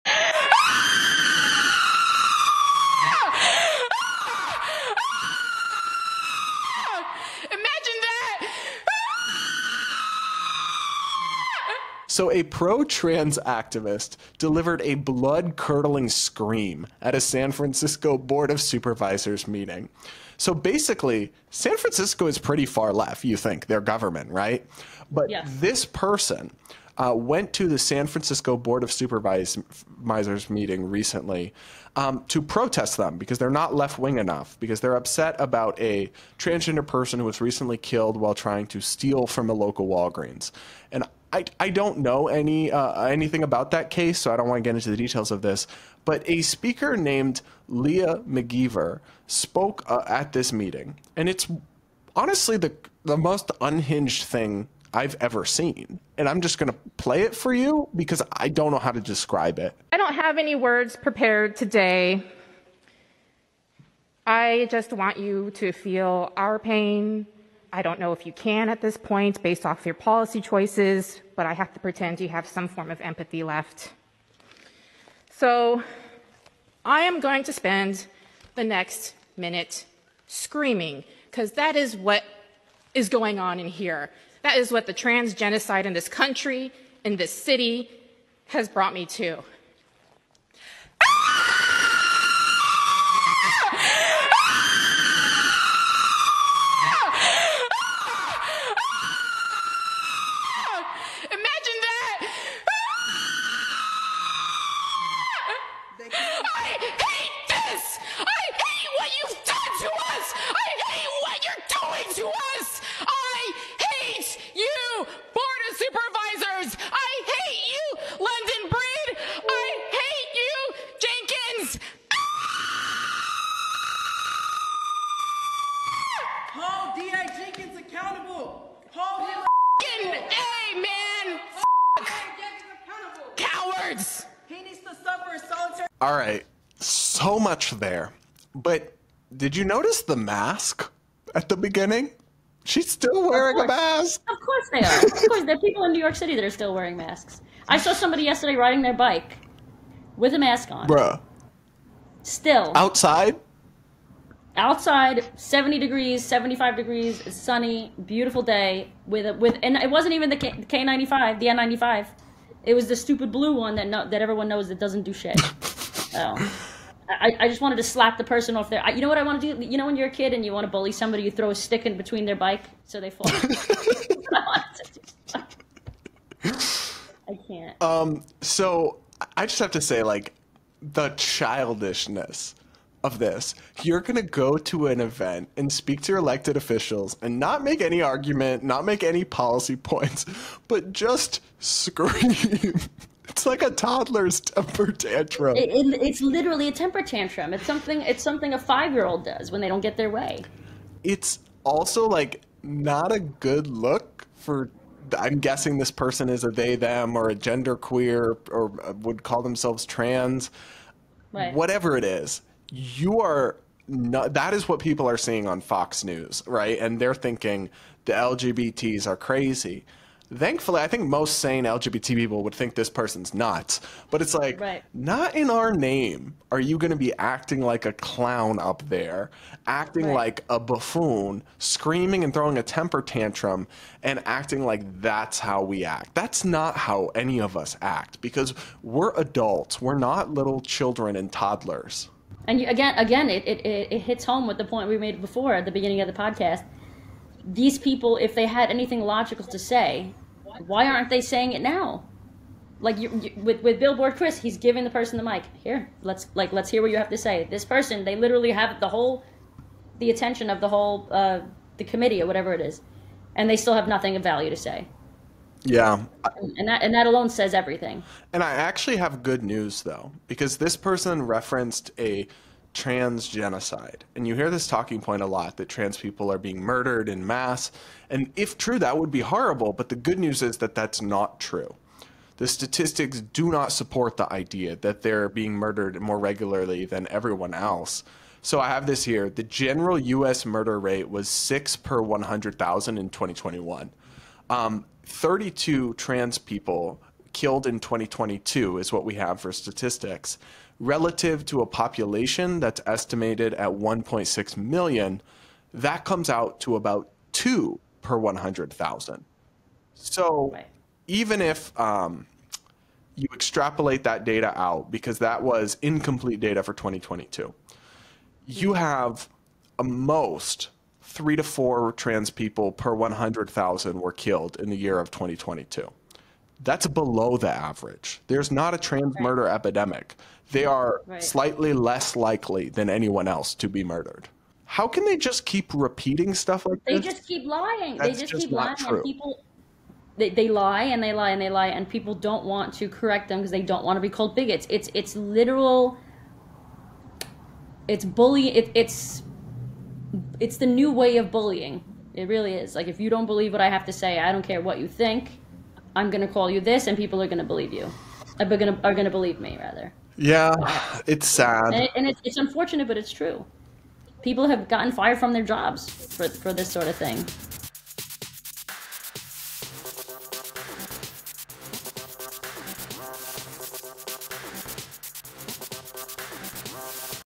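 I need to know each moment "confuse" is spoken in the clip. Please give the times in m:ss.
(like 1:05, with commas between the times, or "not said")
not said.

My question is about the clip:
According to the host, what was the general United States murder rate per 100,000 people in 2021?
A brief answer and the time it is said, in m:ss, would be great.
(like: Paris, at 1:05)
6 per 100,000, at 4:51.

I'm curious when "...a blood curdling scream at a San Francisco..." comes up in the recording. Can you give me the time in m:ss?
0:14.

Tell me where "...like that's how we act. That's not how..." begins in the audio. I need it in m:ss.
3:54.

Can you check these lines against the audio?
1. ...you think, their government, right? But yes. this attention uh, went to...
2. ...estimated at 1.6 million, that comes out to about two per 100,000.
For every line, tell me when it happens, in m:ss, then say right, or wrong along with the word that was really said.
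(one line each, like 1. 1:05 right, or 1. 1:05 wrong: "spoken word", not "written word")
1. 0:23 wrong: "person", not "attention"
2. 5:02 right.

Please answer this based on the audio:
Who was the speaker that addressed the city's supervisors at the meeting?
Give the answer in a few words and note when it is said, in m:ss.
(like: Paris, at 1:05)
Leah McGeever, at 0:47.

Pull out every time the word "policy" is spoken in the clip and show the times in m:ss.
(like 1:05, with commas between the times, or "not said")
1:09, 3:09.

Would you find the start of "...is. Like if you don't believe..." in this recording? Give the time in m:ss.
5:52.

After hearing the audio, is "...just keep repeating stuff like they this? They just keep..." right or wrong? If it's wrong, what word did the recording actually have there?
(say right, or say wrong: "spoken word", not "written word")
right.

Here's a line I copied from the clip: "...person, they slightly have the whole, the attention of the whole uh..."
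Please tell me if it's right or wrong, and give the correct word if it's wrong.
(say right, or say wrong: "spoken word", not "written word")
wrong: "literally", not "slightly".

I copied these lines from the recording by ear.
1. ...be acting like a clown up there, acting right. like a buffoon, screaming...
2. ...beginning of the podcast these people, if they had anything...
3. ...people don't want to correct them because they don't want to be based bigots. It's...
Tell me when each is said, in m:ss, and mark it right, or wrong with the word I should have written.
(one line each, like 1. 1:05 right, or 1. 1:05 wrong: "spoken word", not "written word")
1. 3:46 right
2. 4:05 right
3. 5:41 wrong: "called", not "based".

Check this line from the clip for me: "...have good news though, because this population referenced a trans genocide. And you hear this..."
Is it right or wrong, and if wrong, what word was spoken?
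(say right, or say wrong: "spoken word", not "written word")
wrong: "person", not "population".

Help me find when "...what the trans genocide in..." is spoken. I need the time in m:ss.
1:24.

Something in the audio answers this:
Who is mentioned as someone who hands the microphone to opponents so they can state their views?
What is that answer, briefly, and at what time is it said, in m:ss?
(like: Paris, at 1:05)
Billboard Chris, at 4:13.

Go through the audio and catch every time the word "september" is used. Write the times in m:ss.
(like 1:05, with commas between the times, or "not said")
not said.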